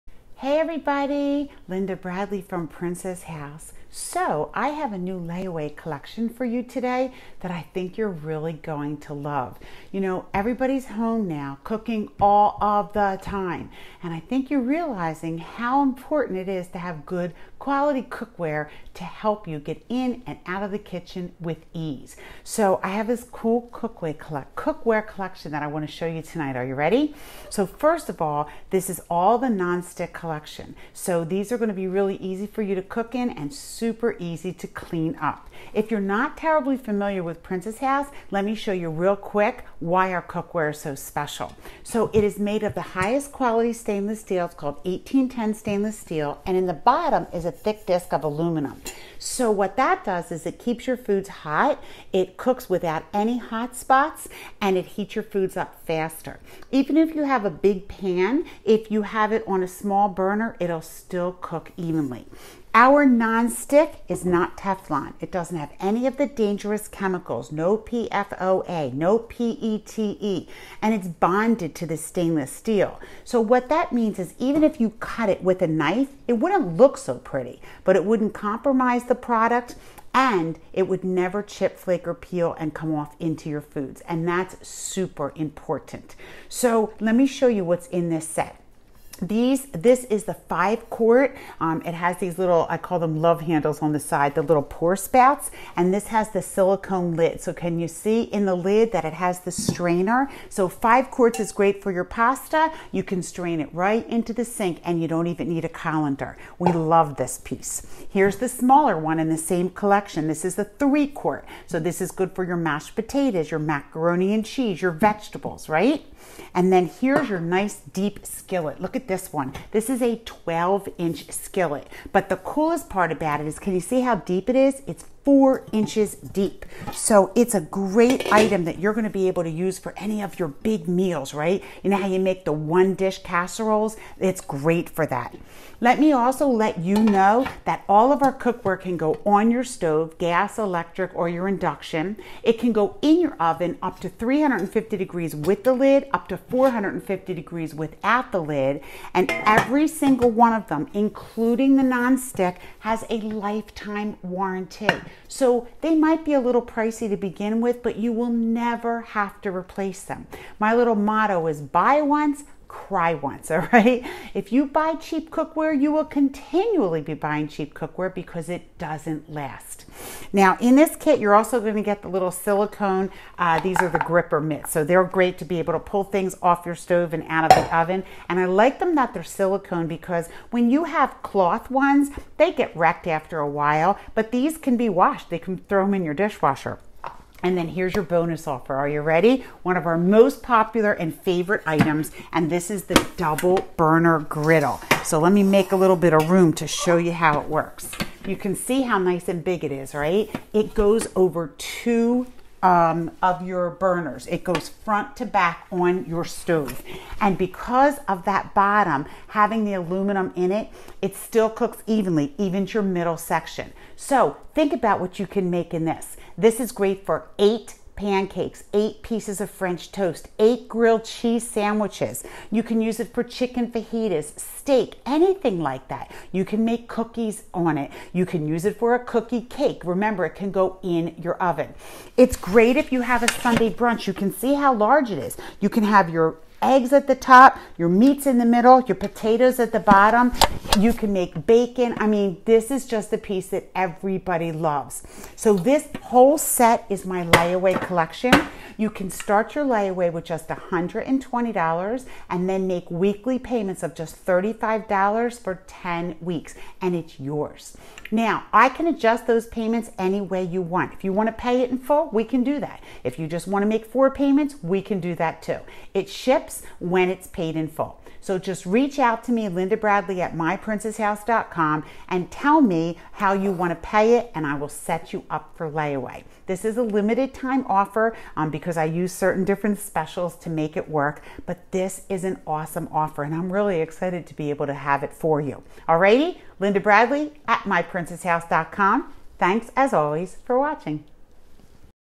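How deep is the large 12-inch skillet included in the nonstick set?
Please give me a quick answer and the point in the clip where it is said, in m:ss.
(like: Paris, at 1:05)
4 inches, at 2:05.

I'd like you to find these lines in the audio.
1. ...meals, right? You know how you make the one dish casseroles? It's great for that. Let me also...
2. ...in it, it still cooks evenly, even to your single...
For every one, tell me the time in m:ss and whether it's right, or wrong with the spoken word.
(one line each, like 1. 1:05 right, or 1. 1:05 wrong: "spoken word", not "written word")
1. 2:10 right
2. 3:30 wrong: "middle", not "single".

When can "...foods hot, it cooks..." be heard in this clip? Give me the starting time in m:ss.
0:50.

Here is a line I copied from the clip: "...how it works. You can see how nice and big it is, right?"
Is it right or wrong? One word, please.
right.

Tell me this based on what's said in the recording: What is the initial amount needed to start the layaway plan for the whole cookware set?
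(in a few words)
$120.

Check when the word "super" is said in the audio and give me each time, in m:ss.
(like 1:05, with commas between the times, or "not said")
0:33, 1:24.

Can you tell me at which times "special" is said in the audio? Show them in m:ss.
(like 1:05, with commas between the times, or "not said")
0:40, 4:39.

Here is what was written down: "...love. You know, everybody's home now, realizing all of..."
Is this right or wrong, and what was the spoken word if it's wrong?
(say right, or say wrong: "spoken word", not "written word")
wrong: "cooking", not "realizing".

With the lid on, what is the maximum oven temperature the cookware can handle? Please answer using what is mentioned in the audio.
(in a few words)
350 degrees.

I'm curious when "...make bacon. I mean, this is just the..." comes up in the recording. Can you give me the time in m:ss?
4:01.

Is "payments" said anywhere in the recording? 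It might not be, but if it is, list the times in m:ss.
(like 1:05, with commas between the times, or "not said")
4:13, 4:19, 4:24.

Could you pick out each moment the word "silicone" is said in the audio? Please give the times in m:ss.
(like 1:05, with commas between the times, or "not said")
1:36, 2:52, 2:59.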